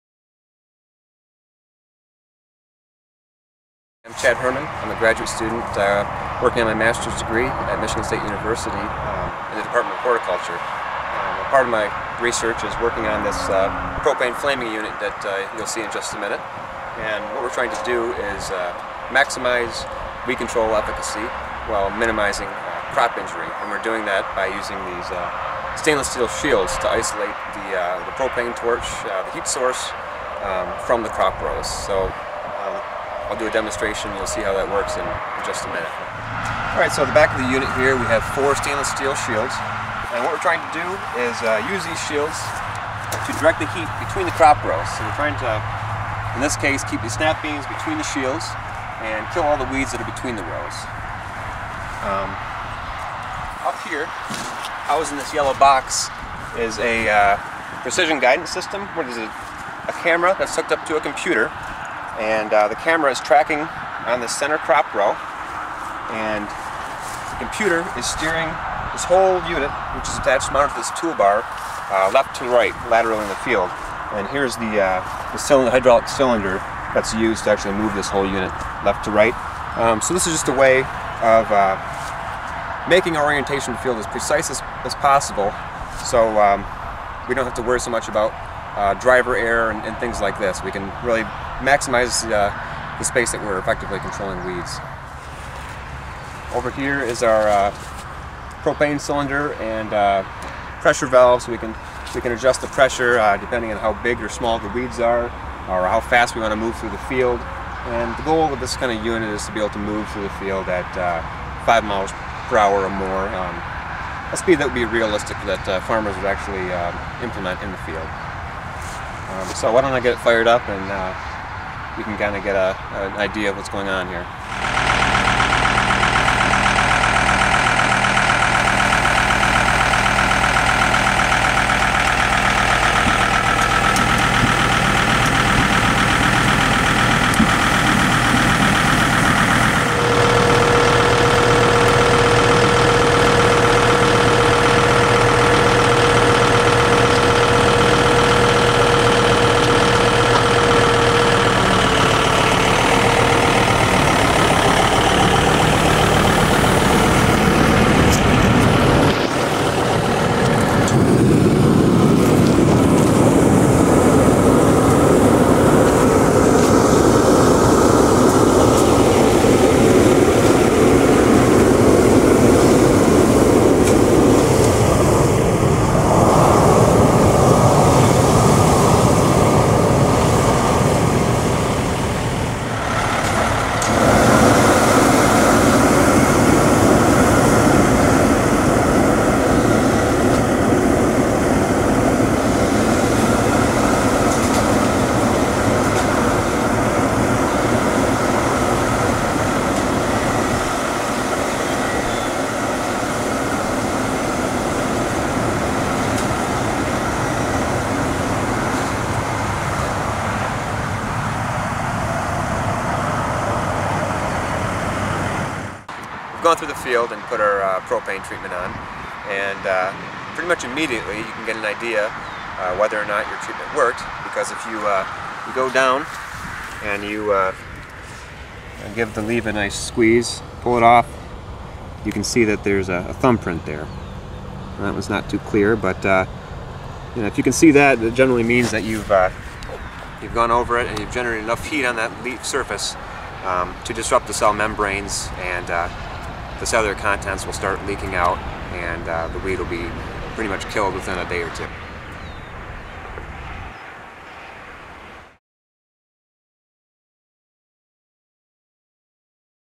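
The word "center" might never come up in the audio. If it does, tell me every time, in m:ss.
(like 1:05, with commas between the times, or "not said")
1:04.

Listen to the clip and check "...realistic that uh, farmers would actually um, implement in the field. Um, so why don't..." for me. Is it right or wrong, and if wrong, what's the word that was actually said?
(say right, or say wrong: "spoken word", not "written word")
right.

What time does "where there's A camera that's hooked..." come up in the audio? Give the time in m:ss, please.
0:58.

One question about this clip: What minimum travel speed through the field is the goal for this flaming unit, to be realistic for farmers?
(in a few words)
5 miles per hour.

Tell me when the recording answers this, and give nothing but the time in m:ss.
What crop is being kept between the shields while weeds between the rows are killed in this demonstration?
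0:47.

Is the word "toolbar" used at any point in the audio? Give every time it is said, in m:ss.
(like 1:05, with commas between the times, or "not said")
1:10.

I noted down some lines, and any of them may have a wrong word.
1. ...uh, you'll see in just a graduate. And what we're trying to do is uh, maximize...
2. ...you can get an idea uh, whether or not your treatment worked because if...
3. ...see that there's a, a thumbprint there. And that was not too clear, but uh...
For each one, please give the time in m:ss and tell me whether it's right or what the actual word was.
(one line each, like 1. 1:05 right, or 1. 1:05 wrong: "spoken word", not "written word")
1. 0:15 wrong: "minute", not "graduate"
2. 3:41 right
3. 3:52 right.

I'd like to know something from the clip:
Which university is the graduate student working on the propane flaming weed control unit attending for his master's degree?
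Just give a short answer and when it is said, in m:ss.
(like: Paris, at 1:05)
Michigan State University, at 0:07.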